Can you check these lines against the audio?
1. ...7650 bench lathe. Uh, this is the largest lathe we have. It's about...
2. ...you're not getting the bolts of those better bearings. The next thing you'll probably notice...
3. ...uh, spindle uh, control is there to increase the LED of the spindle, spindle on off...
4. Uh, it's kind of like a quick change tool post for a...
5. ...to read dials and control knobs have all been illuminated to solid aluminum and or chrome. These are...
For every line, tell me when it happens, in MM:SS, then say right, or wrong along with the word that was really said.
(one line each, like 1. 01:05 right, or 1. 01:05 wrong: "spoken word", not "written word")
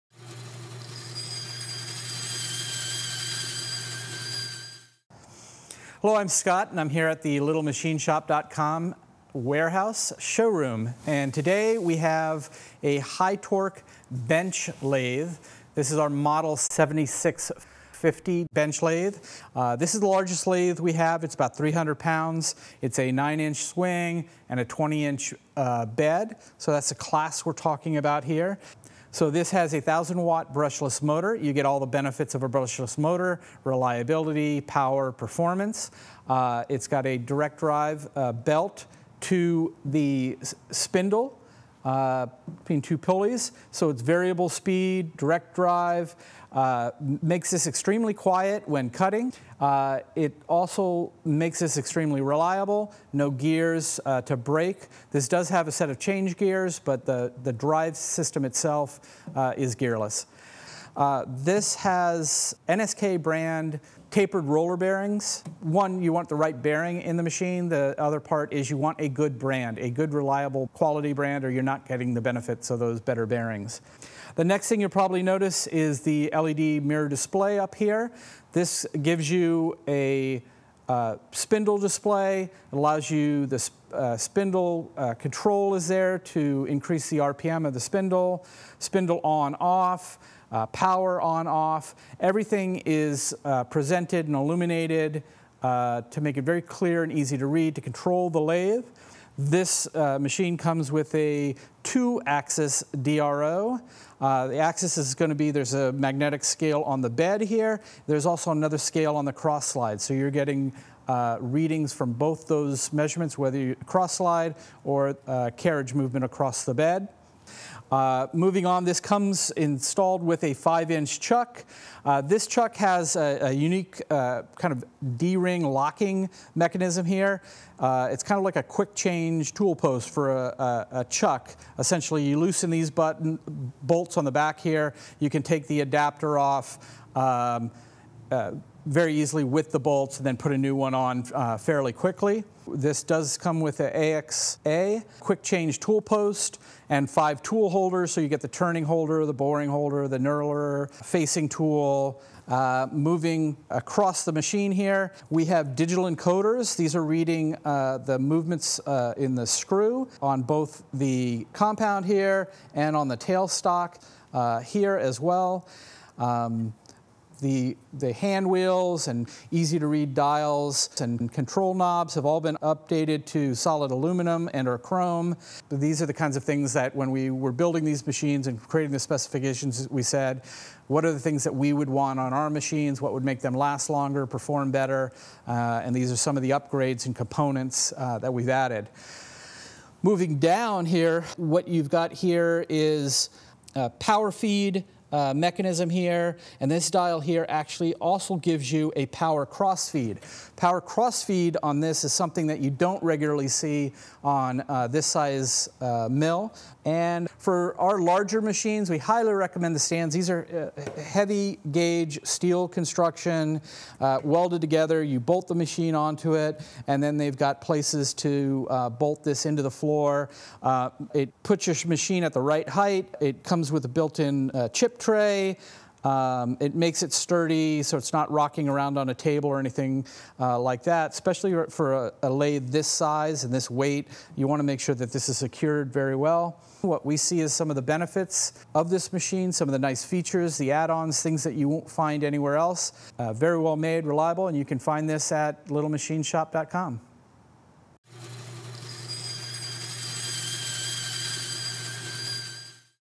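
1. 00:16 right
2. 01:11 wrong: "benefits", not "bolts"
3. 01:23 wrong: "RPM", not "LED"
4. 02:07 right
5. 02:49 wrong: "updated", not "illuminated".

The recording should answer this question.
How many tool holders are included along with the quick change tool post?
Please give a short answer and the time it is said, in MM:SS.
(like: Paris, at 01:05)
5, at 02:27.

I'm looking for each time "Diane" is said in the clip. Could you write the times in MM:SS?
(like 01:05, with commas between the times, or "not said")
not said.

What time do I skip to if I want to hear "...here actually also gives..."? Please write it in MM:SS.
03:17.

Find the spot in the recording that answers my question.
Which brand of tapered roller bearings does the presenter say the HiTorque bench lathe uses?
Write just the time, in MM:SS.
01:02.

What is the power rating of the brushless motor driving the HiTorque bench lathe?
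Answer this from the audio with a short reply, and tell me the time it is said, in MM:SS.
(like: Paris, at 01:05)
1,000 watt, at 00:29.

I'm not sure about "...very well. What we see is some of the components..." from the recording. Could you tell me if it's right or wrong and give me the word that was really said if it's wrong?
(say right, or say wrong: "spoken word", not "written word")
wrong: "benefits", not "components".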